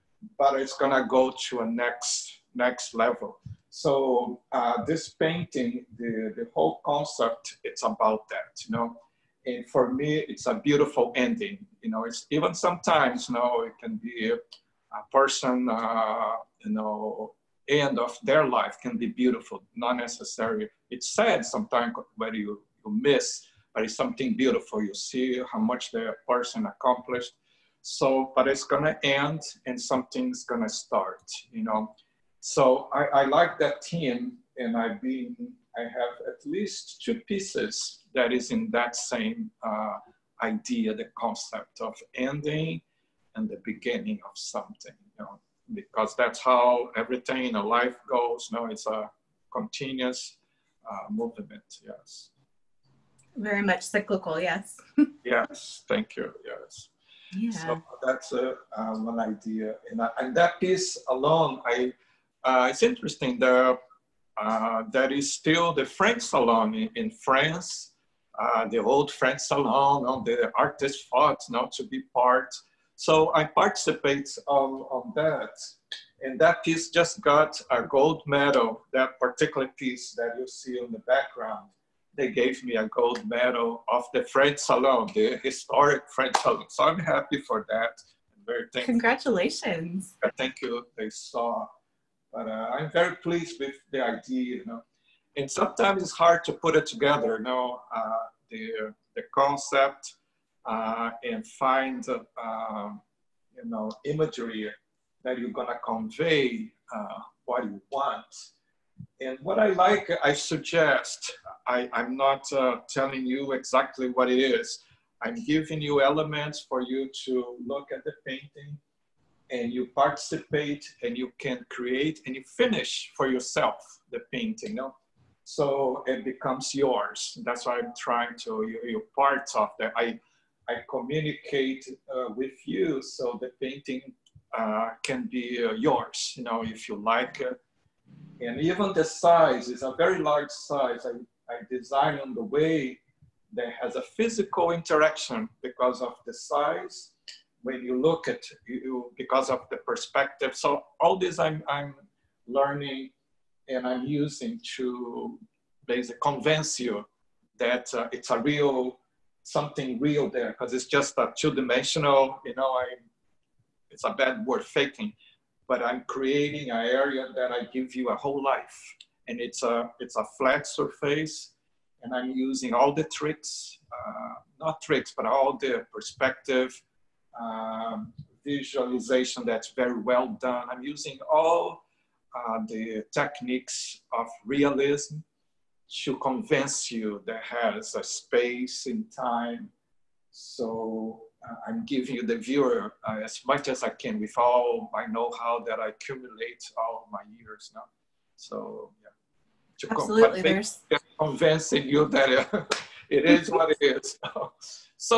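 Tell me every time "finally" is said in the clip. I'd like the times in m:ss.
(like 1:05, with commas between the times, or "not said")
not said.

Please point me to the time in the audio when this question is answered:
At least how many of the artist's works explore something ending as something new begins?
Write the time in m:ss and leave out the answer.
0:37.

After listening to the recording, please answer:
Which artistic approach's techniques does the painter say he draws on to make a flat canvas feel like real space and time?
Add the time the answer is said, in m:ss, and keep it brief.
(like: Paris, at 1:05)
Realism, at 3:04.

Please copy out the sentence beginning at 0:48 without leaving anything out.
You no, know, it's a continuous uh, movement.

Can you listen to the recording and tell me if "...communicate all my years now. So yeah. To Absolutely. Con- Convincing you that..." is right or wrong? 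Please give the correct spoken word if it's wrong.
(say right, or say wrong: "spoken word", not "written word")
wrong: "accumulate", not "communicate".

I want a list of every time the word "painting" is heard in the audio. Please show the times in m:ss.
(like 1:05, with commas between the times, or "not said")
0:05, 1:58, 2:04, 2:13.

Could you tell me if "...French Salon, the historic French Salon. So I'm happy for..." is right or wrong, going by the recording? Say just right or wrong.
right.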